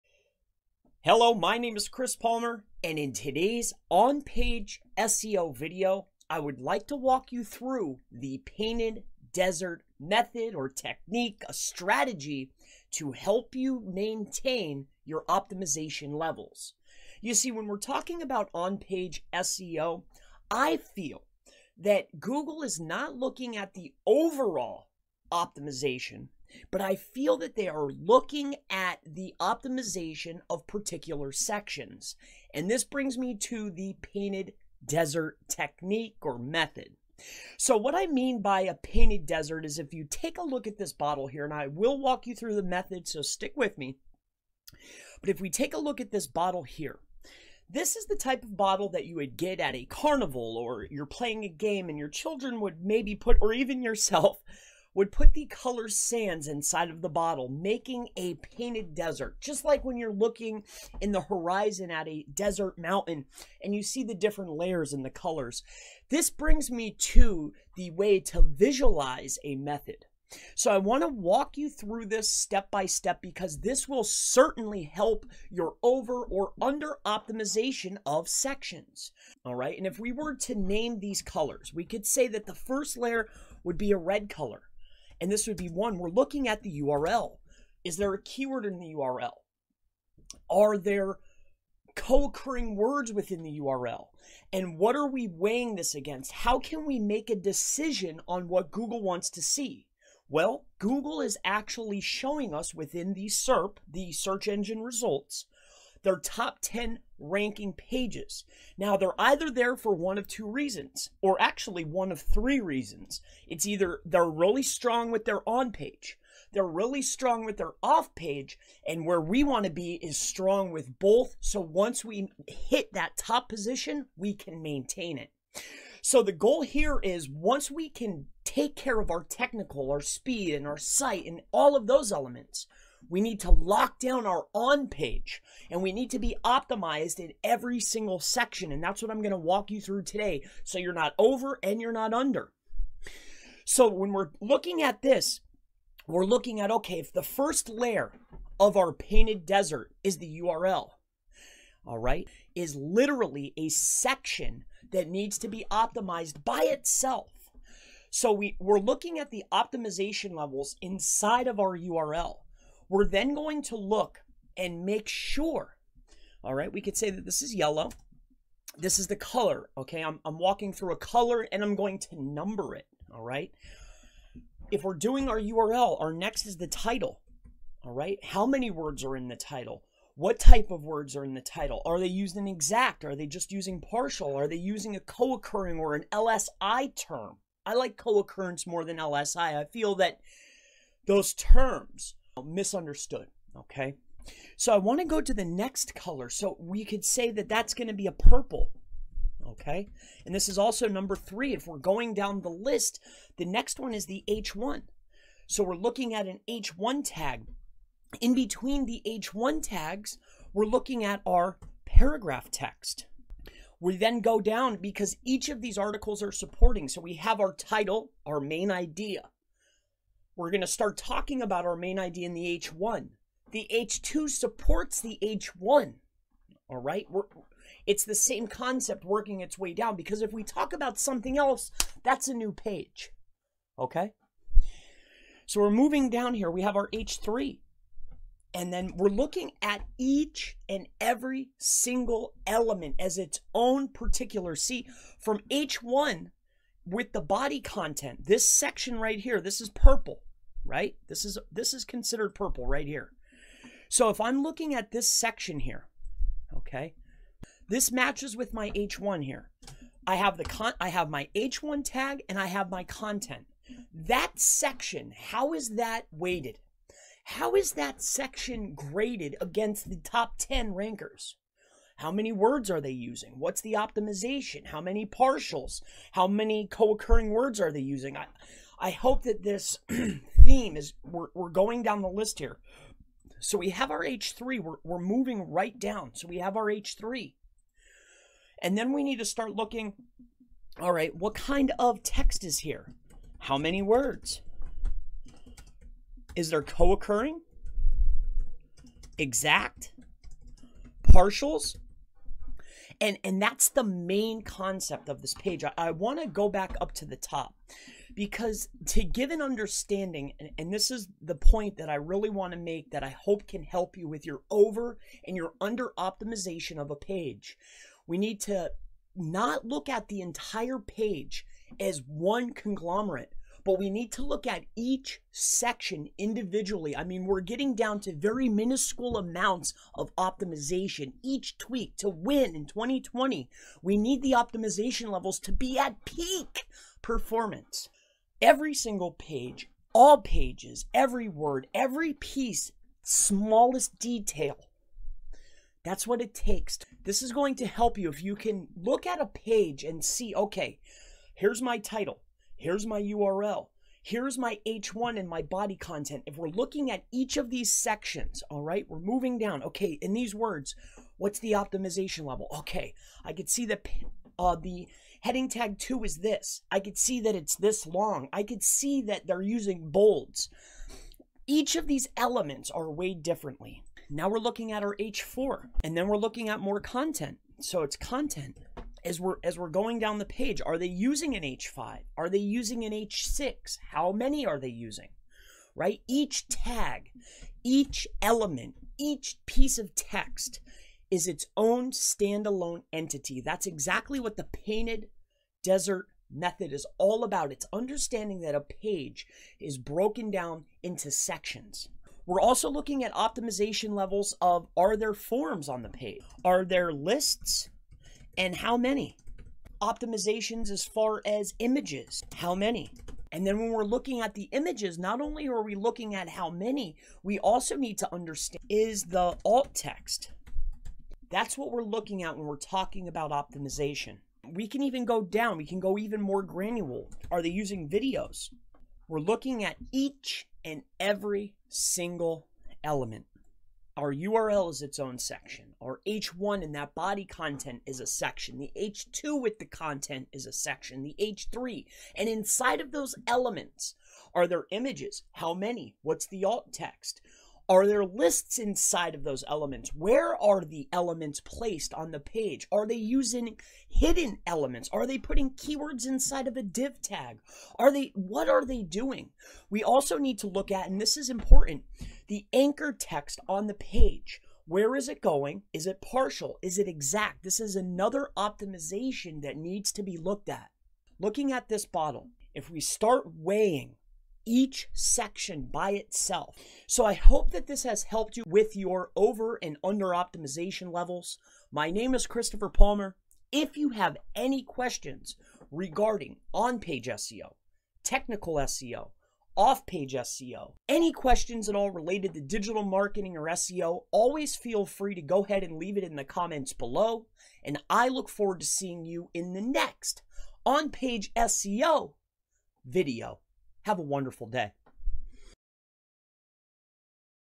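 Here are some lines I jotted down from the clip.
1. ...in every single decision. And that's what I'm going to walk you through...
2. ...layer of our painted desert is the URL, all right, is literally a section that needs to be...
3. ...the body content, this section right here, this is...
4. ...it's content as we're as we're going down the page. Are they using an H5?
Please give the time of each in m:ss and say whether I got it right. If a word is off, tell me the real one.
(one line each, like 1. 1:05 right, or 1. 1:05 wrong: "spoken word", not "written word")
1. 2:17 wrong: "section", not "decision"
2. 2:27 right
3. 4:07 right
4. 6:17 right.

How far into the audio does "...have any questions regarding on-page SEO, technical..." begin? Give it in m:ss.
8:03.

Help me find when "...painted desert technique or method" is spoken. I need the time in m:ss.
0:34.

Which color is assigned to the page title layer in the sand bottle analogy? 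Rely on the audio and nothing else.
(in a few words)
Yellow.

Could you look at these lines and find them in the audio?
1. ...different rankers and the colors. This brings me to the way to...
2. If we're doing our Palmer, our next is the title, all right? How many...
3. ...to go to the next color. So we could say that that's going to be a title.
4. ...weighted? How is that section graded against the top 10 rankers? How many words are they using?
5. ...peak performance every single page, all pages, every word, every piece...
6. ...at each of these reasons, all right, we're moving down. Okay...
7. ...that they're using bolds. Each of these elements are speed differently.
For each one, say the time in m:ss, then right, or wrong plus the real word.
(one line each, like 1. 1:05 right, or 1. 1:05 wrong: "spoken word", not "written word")
1. 1:04 wrong: "layers", not "rankers"
2. 2:54 wrong: "URL", not "Palmer"
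3. 3:14 wrong: "purple", not "title"
4. 4:26 right
5. 5:36 right
6. 5:56 wrong: "sections", not "reasons"
7. 6:09 wrong: "weighed", not "speed".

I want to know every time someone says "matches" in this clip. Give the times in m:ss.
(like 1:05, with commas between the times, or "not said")
4:17.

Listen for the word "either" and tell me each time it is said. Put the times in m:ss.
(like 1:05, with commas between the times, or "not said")
1:49, 1:53.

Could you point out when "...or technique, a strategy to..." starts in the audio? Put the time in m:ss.
0:10.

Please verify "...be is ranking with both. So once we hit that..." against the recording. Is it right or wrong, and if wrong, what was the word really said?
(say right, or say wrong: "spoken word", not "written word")
wrong: "strong", not "ranking".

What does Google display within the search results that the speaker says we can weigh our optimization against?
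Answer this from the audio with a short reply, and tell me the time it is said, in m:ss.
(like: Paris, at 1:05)
top 10 ranking pages, at 1:46.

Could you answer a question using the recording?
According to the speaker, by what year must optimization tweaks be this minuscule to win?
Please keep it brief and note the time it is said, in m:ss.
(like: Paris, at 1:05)
2020, at 5:32.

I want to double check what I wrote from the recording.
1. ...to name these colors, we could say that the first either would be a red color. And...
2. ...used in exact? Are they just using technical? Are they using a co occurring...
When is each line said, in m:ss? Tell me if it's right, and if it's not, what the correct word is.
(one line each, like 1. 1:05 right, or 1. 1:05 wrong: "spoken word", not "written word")
1. 1:20 wrong: "layer", not "either"
2. 3:02 wrong: "partial", not "technical".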